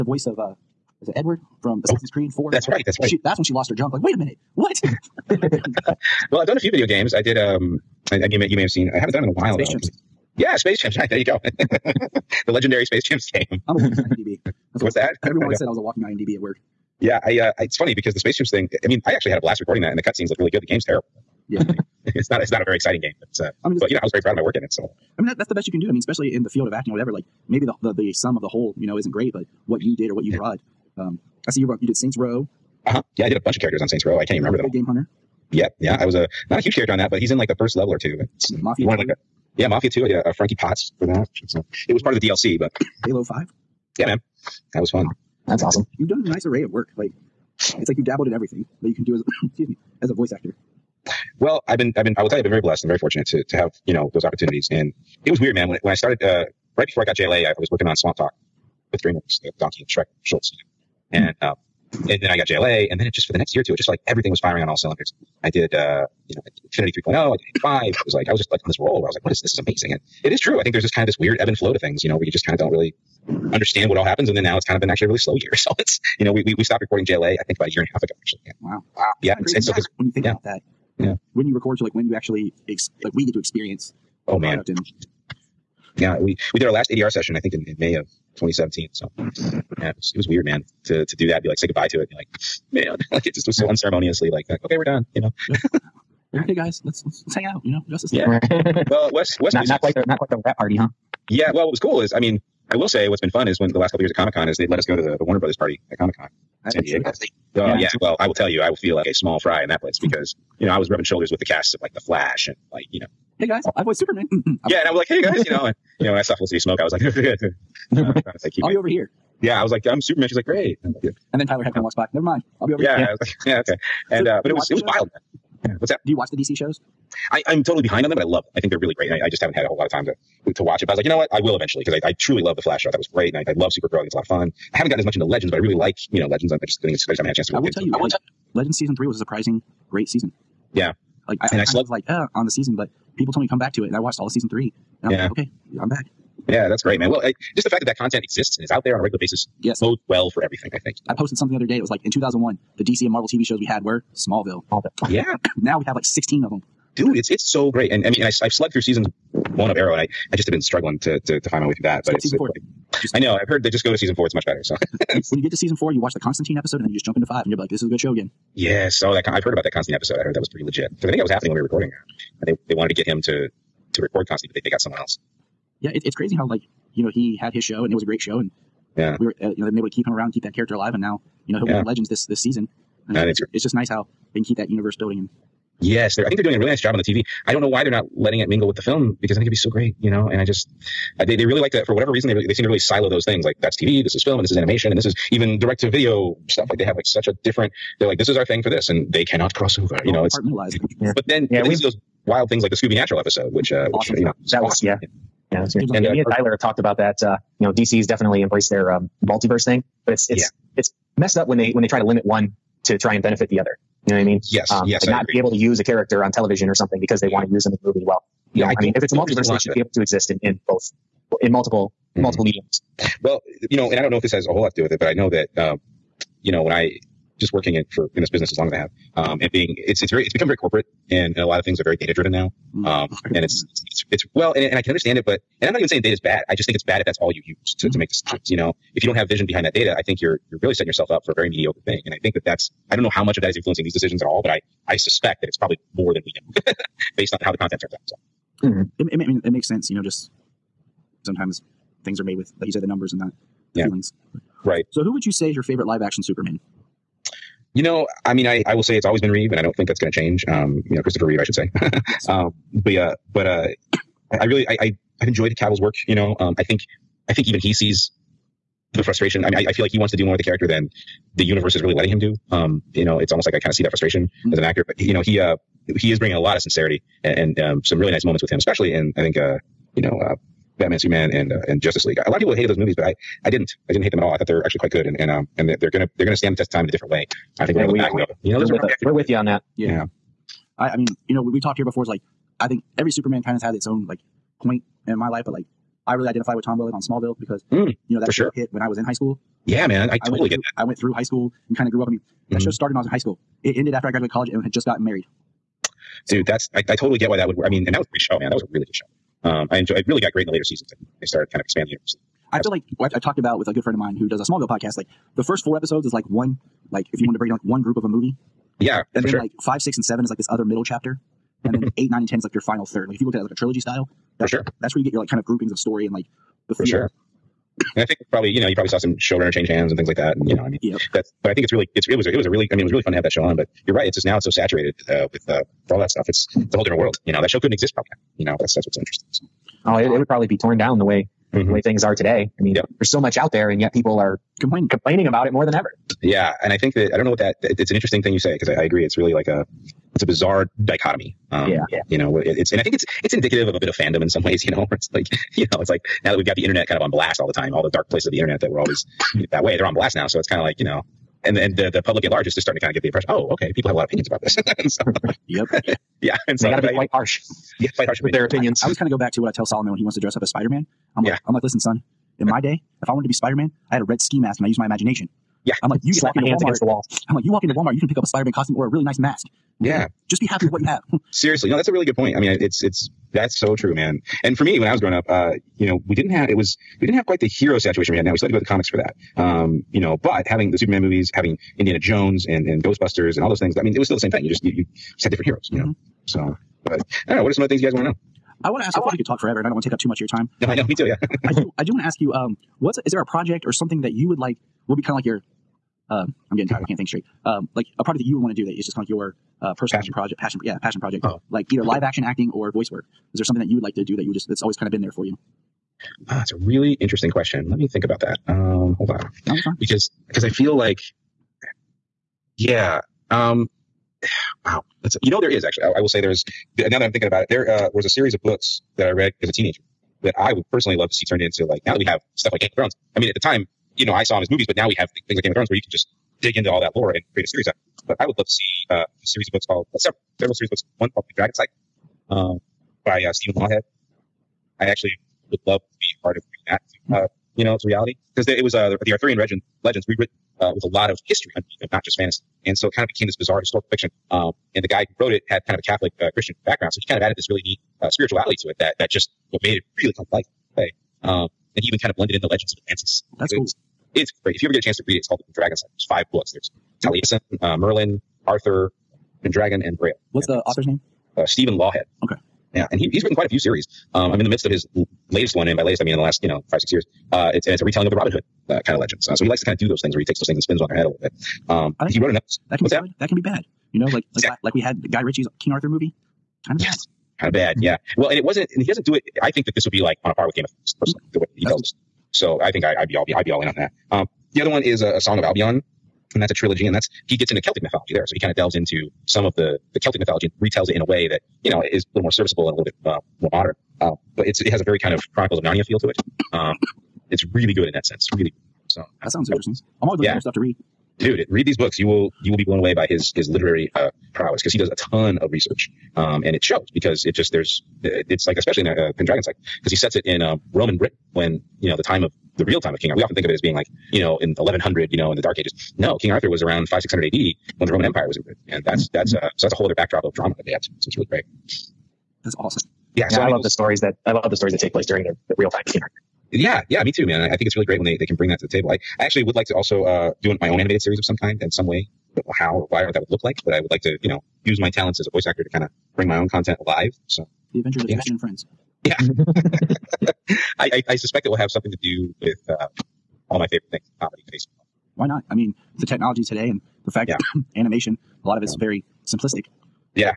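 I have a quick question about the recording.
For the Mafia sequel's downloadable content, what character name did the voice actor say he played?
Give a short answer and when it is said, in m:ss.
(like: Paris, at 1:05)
Frankie Potts, at 0:40.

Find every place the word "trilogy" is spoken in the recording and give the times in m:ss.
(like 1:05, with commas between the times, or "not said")
5:23, 8:16.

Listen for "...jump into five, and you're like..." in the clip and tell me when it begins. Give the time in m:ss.
2:47.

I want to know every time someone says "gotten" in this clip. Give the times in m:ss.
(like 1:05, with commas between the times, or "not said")
2:14, 5:04.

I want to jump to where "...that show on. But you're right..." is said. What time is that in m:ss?
5:33.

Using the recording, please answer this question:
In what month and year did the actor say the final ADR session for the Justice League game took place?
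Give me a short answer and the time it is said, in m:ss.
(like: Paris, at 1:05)
May 2017, at 1:27.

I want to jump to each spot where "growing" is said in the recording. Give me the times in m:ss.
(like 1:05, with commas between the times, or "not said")
6:25.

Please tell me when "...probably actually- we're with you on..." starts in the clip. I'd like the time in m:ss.
4:48.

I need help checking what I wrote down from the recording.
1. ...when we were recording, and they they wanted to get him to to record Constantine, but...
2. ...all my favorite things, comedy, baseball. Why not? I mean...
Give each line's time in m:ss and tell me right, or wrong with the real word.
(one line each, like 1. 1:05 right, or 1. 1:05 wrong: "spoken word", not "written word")
1. 2:51 right
2. 9:13 right.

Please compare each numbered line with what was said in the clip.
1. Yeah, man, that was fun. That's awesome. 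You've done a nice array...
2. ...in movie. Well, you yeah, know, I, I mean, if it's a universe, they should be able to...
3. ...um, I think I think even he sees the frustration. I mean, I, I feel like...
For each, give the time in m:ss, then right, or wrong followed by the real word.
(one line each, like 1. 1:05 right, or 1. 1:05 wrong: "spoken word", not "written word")
1. 0:43 right
2. 3:37 wrong: "multiverse", not "universe"
3. 4:26 right.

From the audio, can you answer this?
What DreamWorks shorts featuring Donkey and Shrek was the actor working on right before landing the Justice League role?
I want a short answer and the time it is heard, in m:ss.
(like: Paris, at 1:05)
Swamp Talk, at 0:57.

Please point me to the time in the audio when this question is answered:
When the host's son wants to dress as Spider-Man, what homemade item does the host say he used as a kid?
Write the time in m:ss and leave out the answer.
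6:14.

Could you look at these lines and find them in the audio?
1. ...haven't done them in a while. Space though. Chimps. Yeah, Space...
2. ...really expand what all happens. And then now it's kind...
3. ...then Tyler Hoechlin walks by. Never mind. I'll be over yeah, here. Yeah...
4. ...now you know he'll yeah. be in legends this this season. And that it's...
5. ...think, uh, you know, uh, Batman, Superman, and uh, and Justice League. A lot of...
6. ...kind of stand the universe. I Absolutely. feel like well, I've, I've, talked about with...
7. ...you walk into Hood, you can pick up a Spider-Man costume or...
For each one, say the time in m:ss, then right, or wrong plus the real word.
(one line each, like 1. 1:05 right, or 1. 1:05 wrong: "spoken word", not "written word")
1. 0:08 right
2. 1:12 wrong: "understand", not "expand"
3. 2:01 right
4. 3:01 right
5. 4:39 right
6. 5:11 wrong: "expand", not "stand"
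7. 6:17 wrong: "Walmart", not "Hood".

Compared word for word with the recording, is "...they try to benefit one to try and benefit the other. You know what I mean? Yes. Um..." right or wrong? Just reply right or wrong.
wrong.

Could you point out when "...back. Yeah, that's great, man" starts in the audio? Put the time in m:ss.
2:25.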